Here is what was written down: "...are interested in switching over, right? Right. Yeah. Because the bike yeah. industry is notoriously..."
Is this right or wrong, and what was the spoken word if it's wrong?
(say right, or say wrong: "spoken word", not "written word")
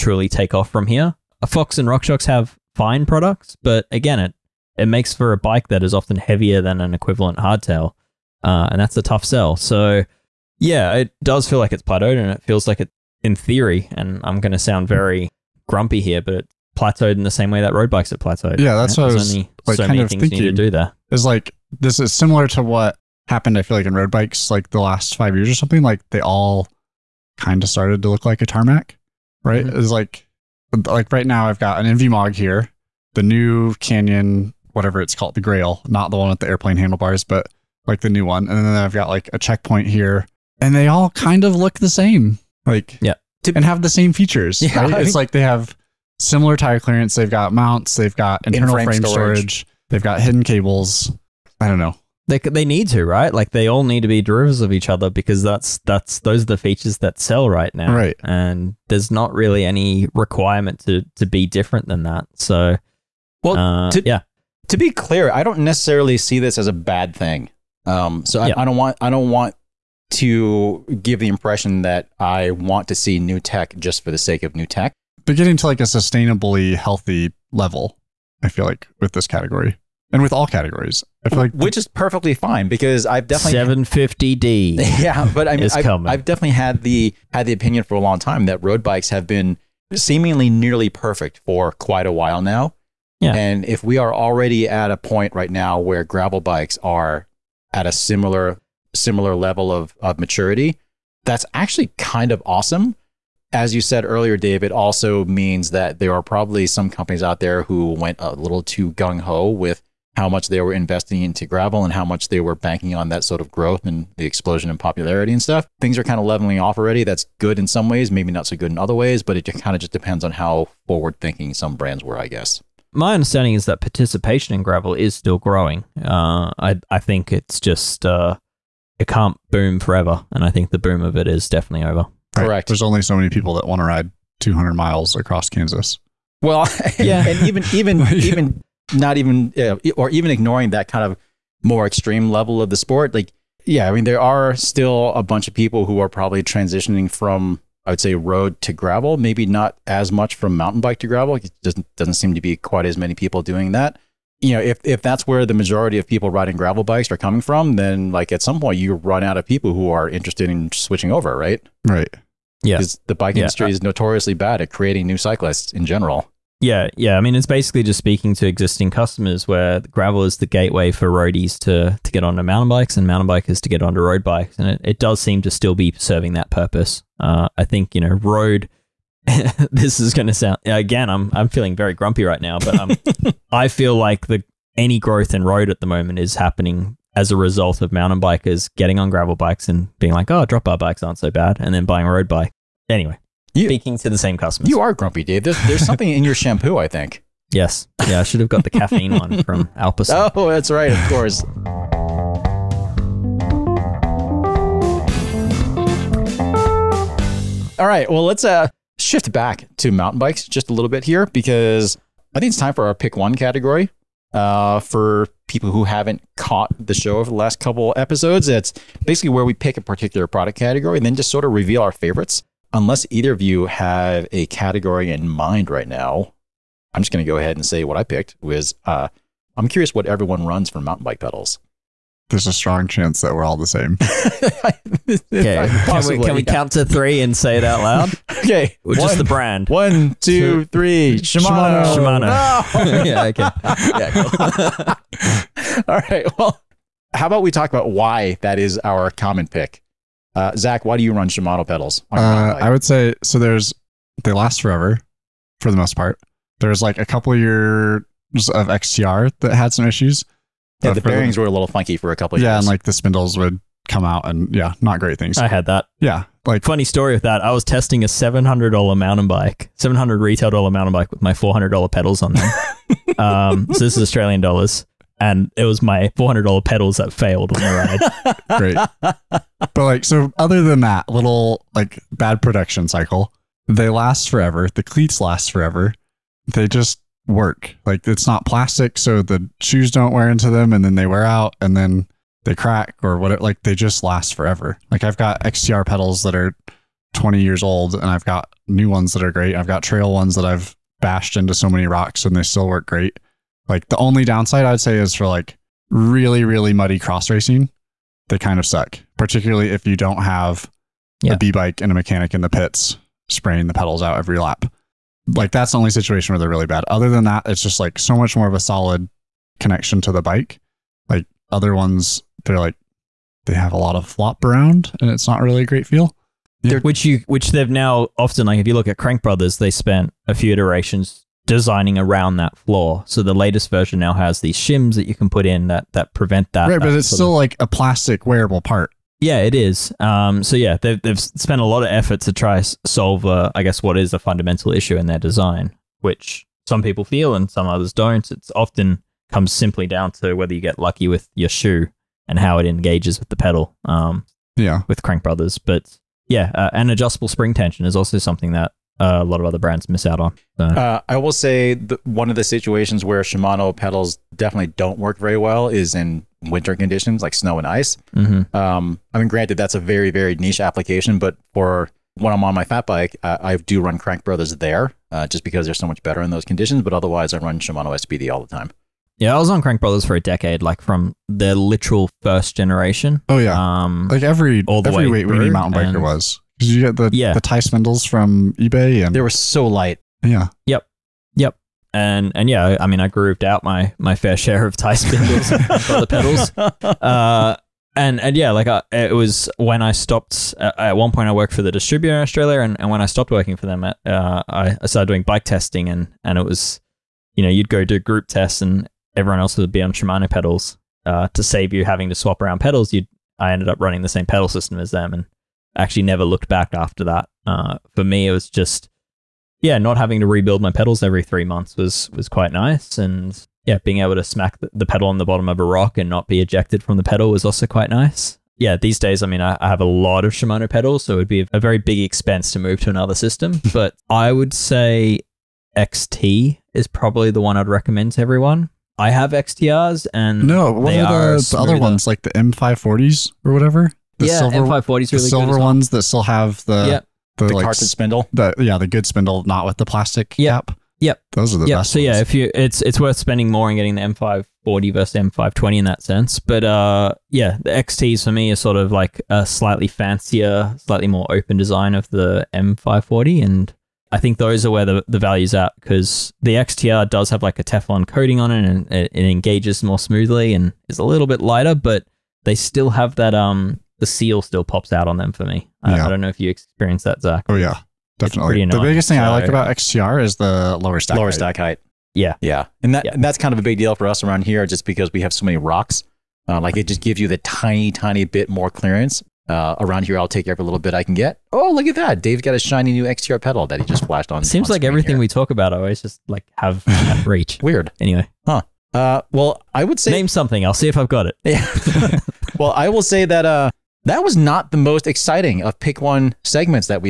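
right.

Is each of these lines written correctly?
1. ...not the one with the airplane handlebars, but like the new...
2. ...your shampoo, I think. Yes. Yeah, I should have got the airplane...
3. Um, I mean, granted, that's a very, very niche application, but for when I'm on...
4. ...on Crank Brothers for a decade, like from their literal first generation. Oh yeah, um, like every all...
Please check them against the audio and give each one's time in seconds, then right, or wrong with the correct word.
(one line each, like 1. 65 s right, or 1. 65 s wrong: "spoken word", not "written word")
1. 35 s right
2. 196 s wrong: "caffeine", not "airplane"
3. 368 s right
4. 379 s right.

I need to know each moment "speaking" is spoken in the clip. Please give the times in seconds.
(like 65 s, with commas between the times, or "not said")
167 s, 193 s.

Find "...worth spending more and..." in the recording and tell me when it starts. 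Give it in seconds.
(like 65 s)
452 s.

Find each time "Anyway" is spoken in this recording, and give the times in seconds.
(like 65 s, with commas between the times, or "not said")
192 s, 497 s.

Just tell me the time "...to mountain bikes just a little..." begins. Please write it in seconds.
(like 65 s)
209 s.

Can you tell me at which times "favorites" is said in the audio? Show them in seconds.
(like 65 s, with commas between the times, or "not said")
221 s.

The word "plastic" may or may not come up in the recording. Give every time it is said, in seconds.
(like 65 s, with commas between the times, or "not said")
288 s, 337 s, 449 s.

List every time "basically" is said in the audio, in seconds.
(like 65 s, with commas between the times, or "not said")
167 s, 219 s.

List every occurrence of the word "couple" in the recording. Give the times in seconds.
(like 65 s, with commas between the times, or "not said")
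217 s, 257 s, 262 s.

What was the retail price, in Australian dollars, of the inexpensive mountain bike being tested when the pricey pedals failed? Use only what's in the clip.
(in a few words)
$700.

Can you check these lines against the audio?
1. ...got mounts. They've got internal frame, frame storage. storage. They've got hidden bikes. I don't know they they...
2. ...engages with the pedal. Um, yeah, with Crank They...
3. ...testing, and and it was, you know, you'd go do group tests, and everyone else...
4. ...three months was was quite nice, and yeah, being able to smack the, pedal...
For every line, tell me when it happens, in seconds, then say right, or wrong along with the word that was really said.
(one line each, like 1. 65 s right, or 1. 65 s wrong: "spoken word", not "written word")
1. 47 s wrong: "cables", not "bikes"
2. 352 s wrong: "Brothers", not "They"
3. 405 s right
4. 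421 s right.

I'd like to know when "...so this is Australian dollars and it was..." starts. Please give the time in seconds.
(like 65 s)
273 s.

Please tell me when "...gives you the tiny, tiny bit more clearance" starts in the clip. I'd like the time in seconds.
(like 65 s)
487 s.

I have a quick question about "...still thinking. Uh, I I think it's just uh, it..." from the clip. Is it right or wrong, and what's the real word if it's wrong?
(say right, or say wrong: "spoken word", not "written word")
wrong: "growing", not "thinking".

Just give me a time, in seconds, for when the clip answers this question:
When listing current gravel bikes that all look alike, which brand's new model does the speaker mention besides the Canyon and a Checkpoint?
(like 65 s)
31 s.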